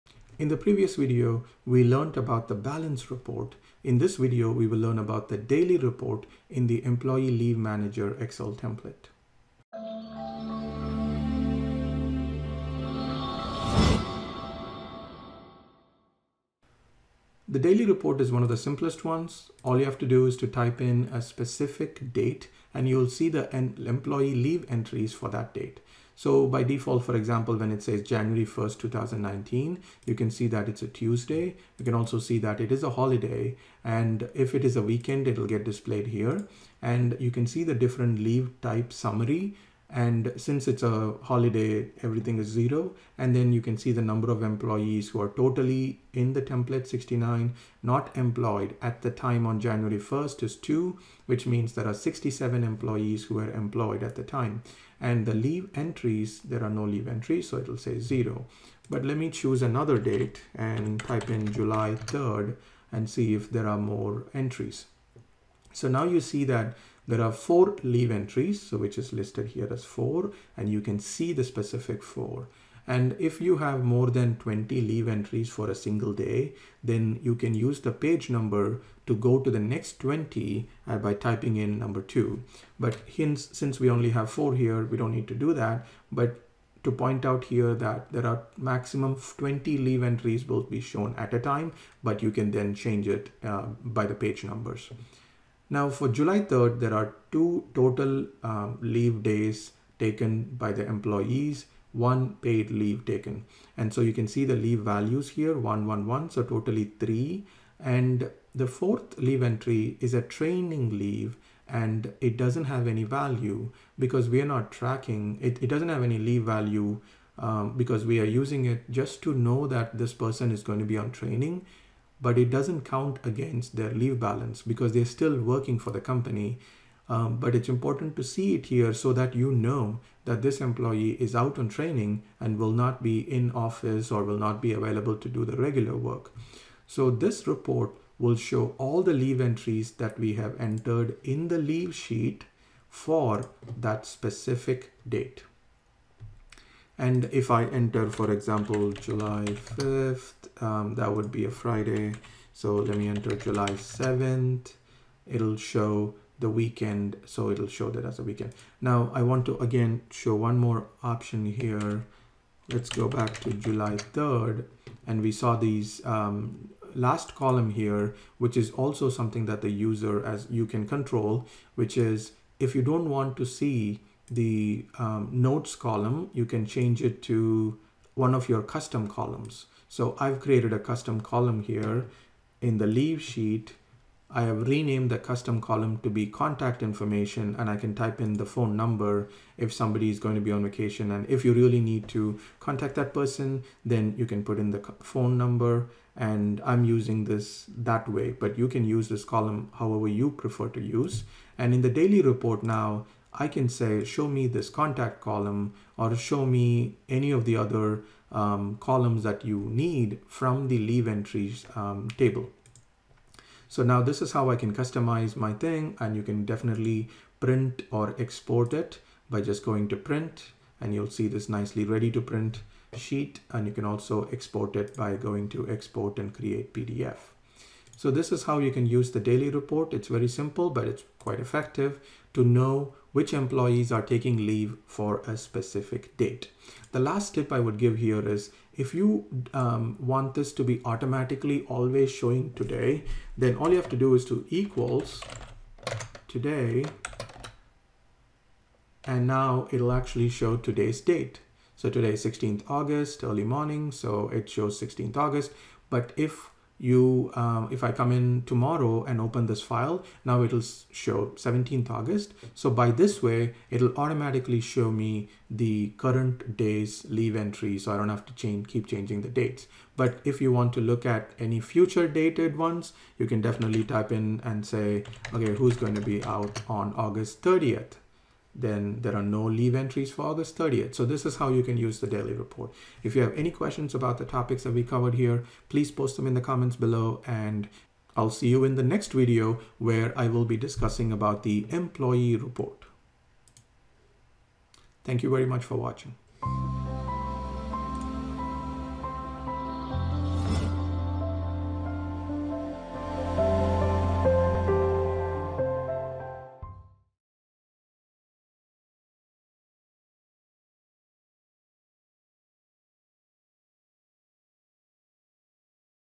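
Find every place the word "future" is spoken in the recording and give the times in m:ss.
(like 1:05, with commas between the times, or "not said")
4:31.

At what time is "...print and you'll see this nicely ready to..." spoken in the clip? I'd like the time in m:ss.
3:39.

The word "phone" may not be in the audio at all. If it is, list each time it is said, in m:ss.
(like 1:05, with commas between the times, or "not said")
3:08, 3:15.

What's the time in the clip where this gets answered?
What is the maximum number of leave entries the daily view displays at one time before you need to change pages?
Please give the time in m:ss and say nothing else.
1:28.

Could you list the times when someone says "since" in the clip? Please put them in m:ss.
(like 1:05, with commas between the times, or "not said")
0:40, 1:23.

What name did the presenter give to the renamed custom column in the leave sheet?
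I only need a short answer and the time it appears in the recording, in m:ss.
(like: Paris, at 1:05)
contact information, at 3:06.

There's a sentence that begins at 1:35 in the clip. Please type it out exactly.
Now for July 3rd, there are two total um, leave days taken by the employees, one paid leave taken.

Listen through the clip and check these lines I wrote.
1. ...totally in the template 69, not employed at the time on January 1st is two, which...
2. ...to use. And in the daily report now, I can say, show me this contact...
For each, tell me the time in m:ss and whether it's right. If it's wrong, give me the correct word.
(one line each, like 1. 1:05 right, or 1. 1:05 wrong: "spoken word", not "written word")
1. 0:45 right
2. 3:20 right.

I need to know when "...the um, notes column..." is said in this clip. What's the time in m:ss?
2:54.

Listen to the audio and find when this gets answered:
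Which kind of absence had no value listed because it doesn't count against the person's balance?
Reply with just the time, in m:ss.
1:50.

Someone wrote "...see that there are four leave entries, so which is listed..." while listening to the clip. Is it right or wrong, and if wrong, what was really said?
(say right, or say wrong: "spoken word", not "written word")
right.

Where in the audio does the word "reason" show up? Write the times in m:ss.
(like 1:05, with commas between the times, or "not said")
not said.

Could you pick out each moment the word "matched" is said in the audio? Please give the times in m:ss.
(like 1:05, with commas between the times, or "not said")
not said.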